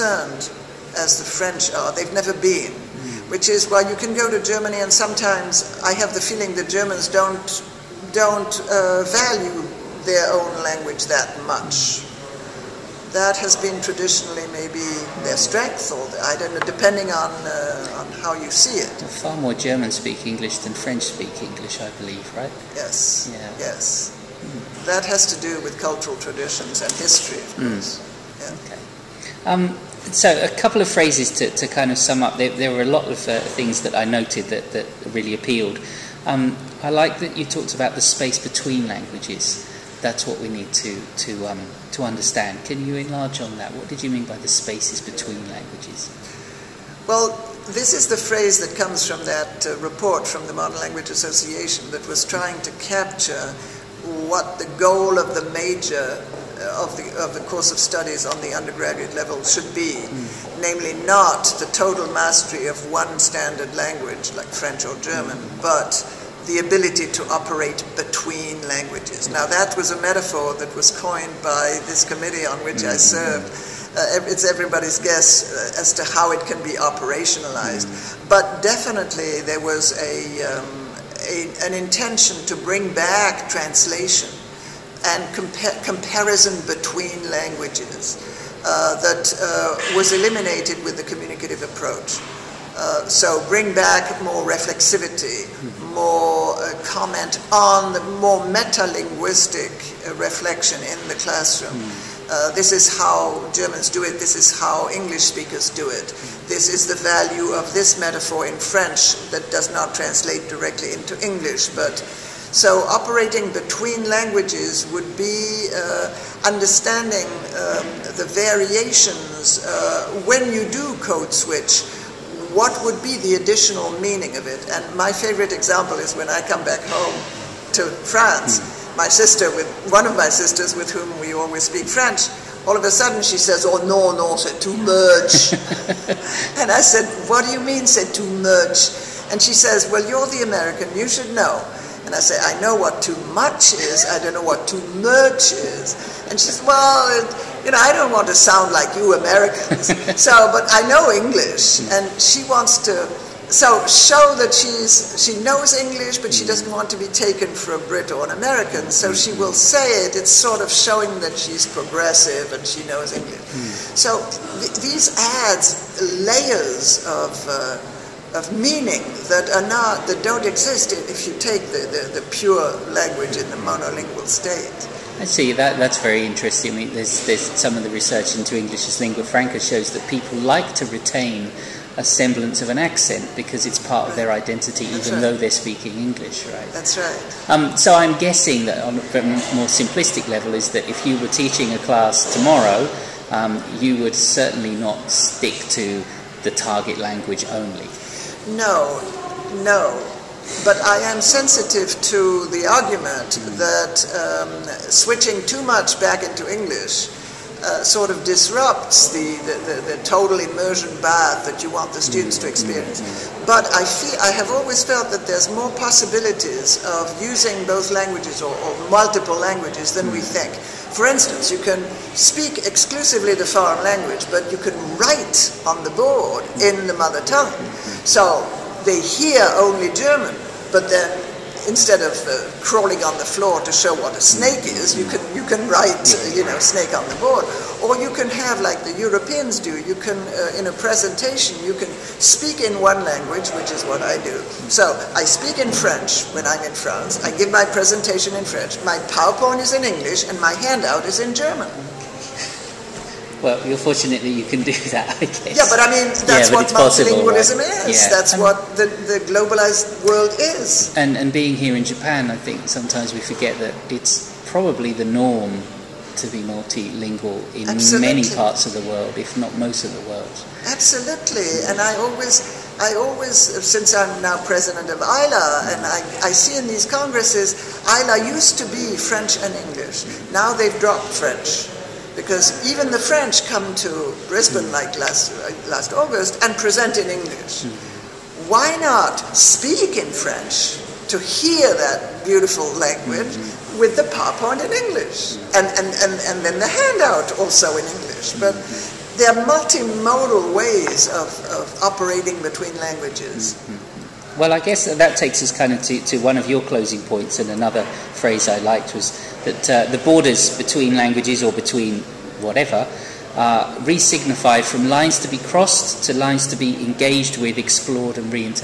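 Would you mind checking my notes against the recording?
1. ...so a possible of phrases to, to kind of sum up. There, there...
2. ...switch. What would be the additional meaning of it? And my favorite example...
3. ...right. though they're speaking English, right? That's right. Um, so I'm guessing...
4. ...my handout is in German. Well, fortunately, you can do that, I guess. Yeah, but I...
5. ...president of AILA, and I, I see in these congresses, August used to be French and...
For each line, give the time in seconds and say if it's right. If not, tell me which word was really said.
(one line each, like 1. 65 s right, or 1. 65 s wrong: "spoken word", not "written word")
1. 30 s wrong: "couple", not "possible"
2. 121 s right
3. 185 s right
4. 250 s right
5. 274 s wrong: "AILA", not "August".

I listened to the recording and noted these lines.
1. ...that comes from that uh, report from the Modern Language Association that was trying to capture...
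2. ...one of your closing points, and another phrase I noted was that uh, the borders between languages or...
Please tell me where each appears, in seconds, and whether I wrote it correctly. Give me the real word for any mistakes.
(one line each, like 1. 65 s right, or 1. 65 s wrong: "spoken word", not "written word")
1. 48 s right
2. 306 s wrong: "liked", not "noted".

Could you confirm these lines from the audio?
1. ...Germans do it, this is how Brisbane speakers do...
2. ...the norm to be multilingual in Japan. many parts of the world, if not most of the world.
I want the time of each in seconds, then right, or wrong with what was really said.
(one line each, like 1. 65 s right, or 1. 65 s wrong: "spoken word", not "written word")
1. 103 s wrong: "English", not "Brisbane"
2. 264 s wrong: "Absolutely", not "Japan".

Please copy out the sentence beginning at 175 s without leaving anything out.
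I see that that's very interesting.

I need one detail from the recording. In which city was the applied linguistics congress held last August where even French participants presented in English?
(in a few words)
Brisbane.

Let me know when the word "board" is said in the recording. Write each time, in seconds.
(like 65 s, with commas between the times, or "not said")
225 s, 237 s.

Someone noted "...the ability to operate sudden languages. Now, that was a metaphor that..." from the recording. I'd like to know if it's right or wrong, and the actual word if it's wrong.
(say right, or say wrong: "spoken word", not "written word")
wrong: "between", not "sudden".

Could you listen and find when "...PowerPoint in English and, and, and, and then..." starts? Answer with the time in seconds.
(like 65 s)
294 s.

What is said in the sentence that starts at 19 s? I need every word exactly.
far more Germans speak English than French speak English, I believe, right?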